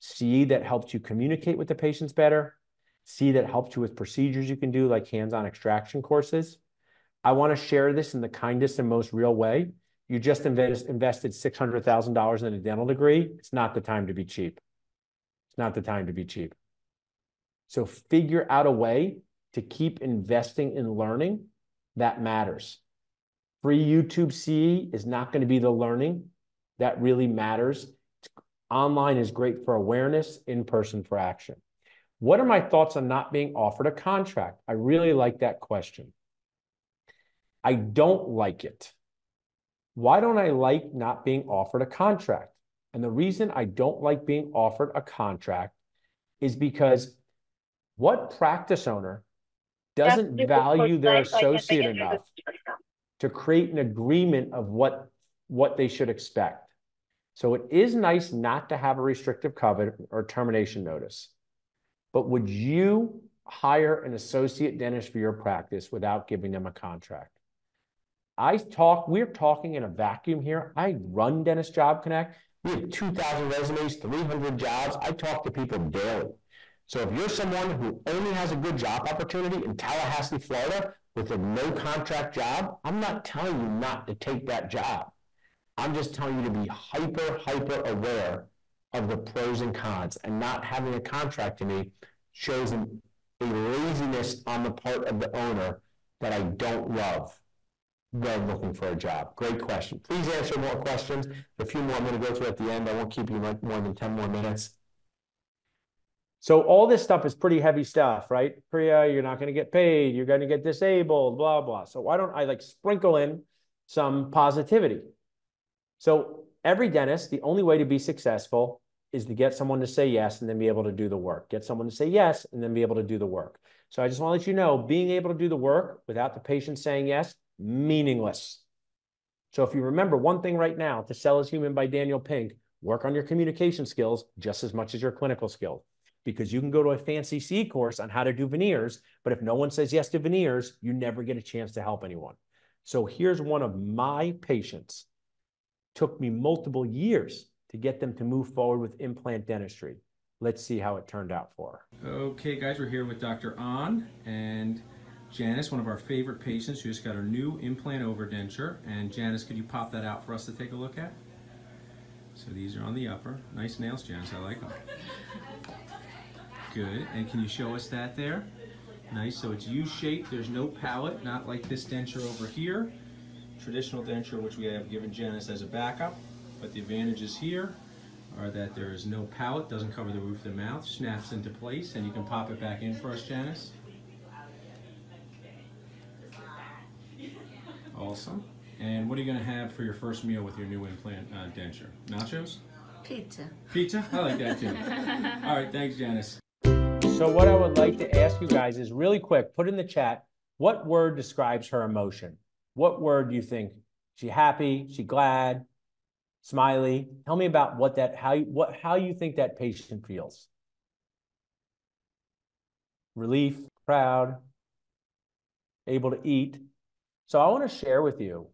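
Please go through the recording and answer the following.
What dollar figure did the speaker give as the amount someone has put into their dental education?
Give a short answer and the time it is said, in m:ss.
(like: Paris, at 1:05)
$600,000, at 0:11.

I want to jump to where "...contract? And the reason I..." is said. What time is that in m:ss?
0:41.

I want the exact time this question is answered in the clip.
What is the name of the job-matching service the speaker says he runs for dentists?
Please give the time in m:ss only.
1:11.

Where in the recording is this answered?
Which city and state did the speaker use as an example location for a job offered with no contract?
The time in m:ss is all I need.
1:19.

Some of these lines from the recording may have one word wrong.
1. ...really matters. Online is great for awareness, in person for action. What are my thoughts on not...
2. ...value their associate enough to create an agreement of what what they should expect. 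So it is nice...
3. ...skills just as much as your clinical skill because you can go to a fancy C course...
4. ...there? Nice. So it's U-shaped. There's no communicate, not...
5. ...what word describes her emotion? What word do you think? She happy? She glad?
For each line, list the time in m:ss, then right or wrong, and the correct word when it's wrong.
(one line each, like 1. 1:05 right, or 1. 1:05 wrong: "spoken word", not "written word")
1. 0:27 right
2. 0:50 right
3. 2:13 right
4. 2:48 wrong: "palate", not "communicate"
5. 3:20 right.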